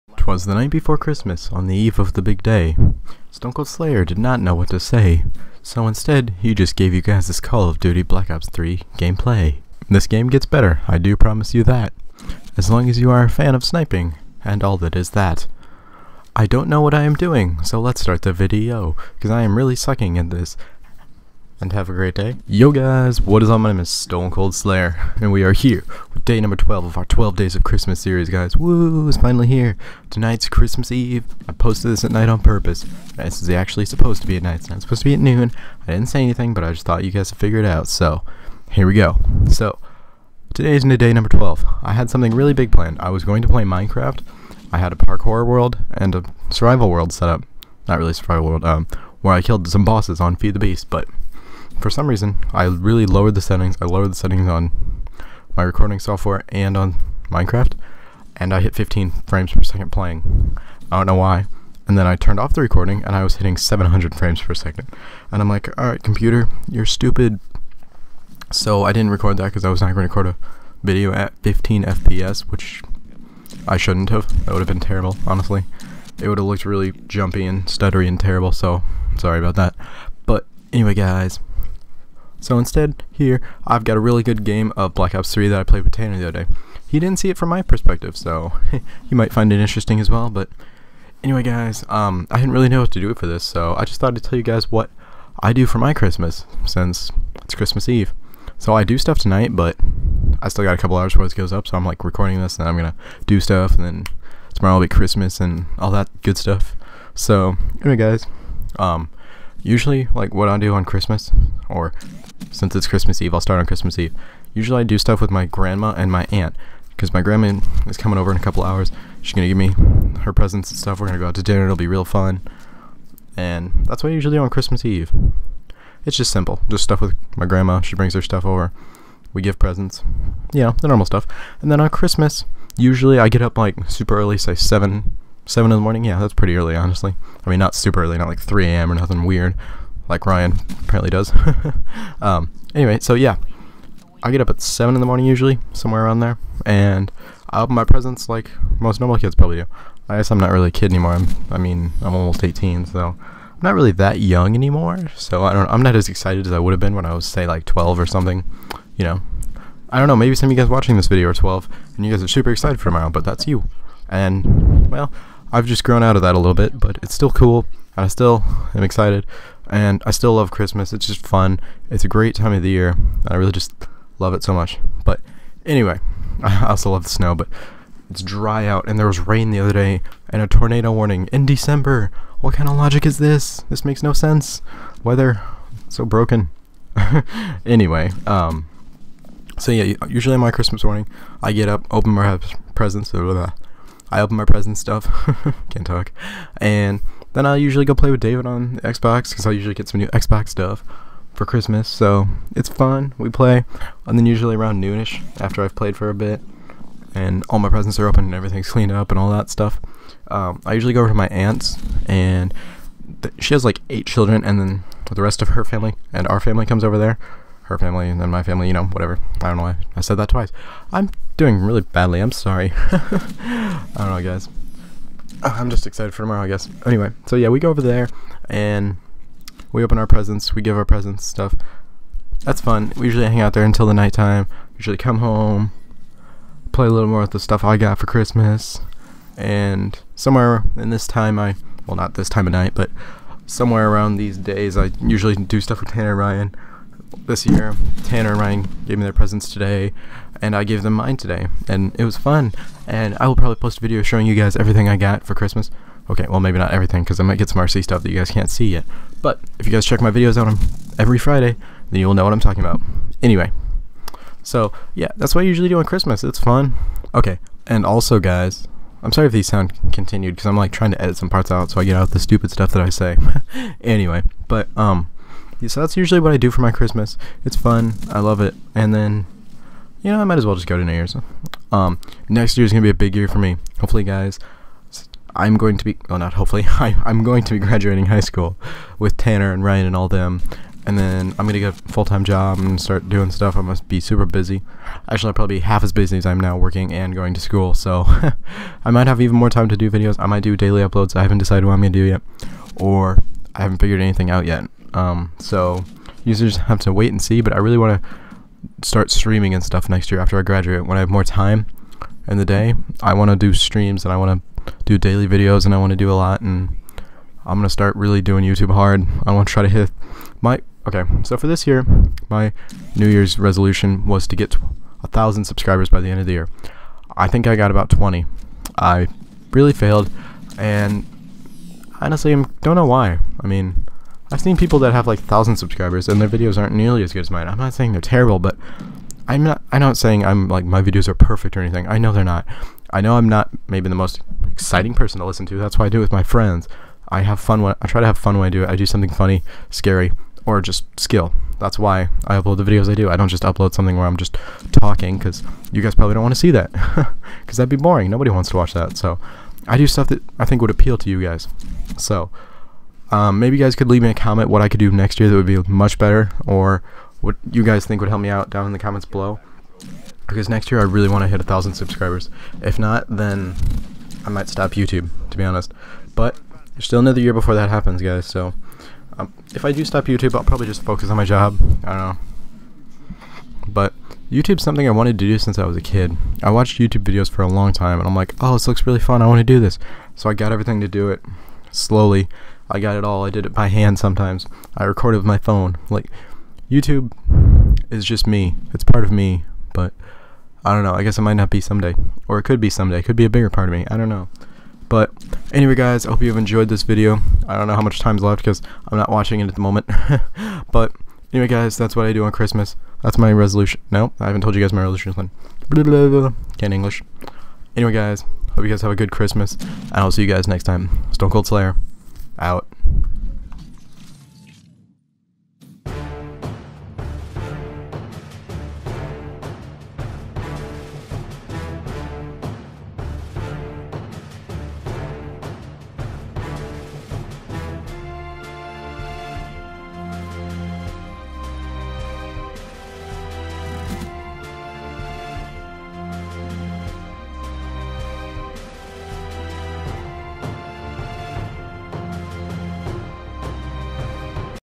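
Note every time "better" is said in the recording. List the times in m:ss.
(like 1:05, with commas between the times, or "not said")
0:10, 6:05.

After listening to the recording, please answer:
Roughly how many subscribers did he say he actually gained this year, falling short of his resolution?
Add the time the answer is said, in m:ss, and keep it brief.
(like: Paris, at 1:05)
20, at 5:27.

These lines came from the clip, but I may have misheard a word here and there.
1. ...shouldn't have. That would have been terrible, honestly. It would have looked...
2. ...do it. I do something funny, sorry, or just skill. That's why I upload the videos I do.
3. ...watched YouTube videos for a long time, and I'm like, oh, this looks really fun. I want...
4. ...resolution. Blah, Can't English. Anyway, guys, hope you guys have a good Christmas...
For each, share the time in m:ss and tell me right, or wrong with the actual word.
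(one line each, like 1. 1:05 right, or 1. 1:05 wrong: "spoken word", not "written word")
1. 1:13 right
2. 5:48 wrong: "scary", not "sorry"
3. 6:26 right
4. 6:54 right.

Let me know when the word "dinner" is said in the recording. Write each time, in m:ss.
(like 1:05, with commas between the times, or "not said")
2:01.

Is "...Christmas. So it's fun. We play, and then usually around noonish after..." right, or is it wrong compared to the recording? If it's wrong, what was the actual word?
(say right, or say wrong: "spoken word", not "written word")
right.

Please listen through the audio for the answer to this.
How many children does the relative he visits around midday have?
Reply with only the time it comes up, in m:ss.
3:33.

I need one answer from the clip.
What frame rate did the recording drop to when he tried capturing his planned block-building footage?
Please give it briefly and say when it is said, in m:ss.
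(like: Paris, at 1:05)
15 frames per second, at 0:58.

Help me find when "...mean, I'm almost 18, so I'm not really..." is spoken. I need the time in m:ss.
2:31.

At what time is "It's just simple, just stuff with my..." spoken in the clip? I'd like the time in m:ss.
2:06.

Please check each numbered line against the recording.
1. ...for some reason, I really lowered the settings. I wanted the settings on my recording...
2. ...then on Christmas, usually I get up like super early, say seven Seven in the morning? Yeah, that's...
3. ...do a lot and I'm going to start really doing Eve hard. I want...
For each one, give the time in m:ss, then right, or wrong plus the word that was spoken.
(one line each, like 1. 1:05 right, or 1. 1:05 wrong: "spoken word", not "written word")
1. 0:51 wrong: "lowered", not "wanted"
2. 2:11 right
3. 5:15 wrong: "YouTube", not "Eve".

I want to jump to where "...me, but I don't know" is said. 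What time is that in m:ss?
6:39.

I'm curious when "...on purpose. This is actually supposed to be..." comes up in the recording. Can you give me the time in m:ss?
0:32.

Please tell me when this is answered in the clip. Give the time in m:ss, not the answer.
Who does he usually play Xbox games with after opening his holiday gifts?
3:18.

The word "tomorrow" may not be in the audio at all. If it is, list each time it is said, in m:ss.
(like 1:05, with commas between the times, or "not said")
1:44, 2:42, 3:46.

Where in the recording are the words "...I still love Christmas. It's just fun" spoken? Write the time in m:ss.
2:50.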